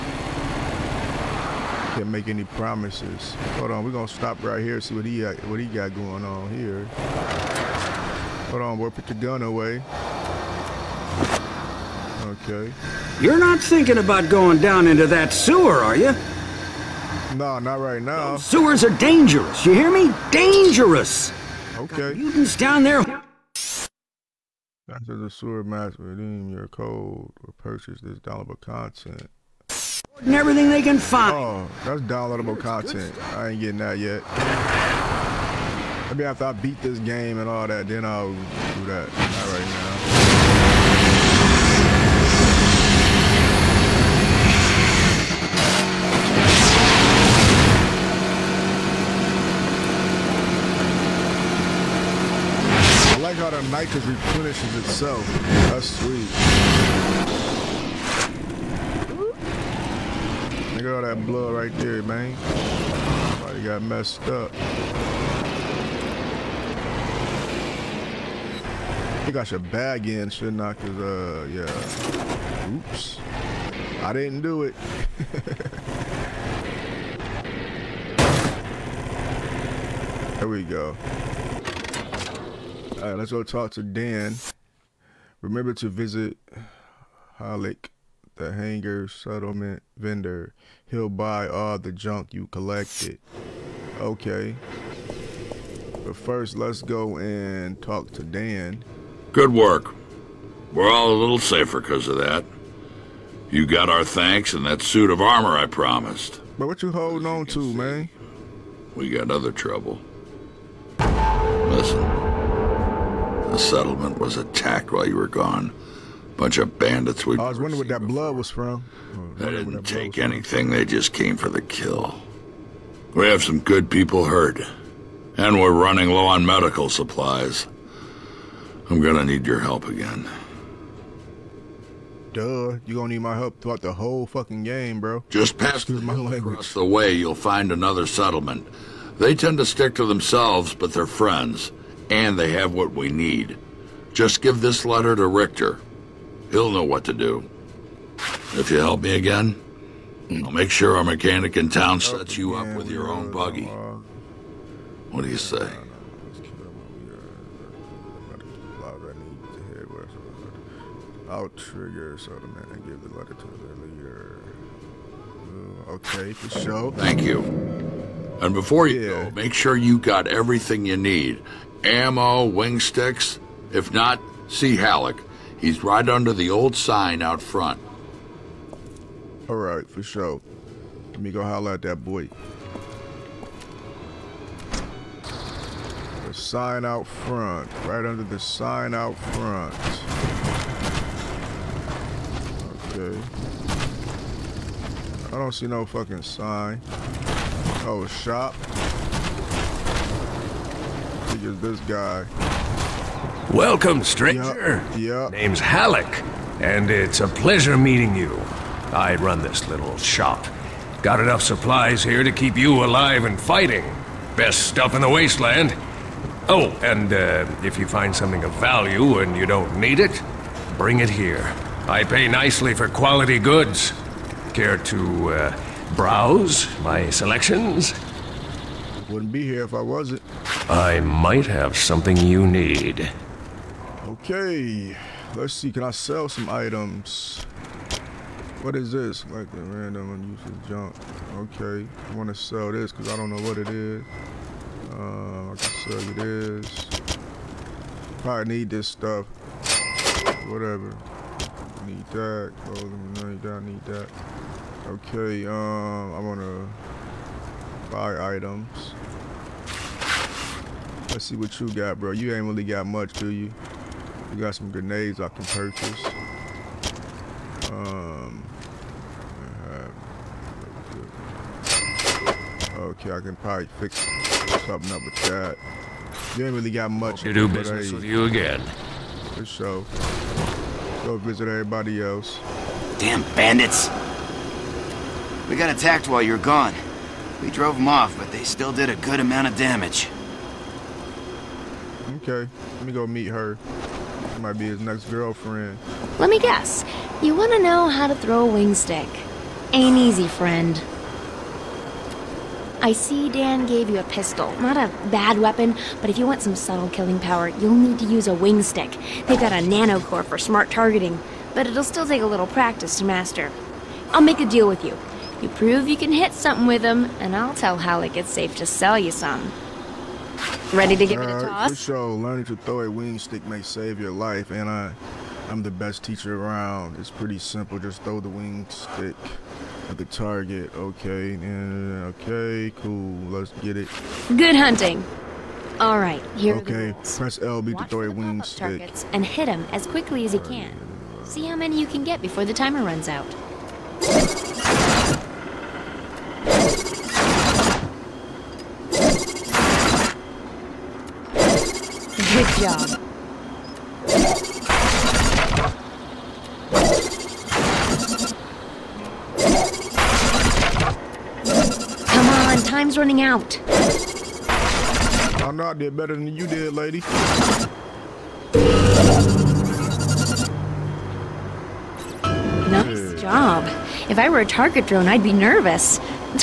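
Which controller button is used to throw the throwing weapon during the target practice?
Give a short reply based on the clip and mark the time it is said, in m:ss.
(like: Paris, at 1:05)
LB, at 5:37.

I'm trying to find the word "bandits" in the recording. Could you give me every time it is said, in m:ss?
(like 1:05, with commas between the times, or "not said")
1:56, 4:43.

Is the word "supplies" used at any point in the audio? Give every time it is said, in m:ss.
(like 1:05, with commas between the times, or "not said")
2:06, 3:31.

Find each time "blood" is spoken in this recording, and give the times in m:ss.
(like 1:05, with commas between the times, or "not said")
1:01, 1:58.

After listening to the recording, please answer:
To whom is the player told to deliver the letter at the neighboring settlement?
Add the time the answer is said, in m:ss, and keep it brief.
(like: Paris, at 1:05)
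Richter, at 2:25.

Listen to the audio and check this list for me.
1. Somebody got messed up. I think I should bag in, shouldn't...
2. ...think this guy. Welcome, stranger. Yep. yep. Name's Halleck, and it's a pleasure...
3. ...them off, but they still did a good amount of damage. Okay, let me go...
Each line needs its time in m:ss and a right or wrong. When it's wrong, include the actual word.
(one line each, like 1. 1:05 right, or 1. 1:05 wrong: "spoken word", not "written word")
1. 1:03 right
2. 3:21 right
3. 4:47 right.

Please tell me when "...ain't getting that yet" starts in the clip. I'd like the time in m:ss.
0:33.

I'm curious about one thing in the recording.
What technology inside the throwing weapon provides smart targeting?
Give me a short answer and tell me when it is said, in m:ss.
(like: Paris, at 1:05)
Nano core, at 5:09.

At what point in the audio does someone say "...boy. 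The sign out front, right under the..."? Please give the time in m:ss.
3:02.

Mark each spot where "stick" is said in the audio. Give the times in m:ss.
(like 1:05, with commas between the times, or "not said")
2:19, 2:52, 4:58, 5:08, 5:23, 5:28, 5:38.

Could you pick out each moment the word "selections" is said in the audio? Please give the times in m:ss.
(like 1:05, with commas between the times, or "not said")
3:47.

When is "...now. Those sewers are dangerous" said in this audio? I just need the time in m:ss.
0:18.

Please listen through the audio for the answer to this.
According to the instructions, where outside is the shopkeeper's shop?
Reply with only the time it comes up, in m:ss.
2:55.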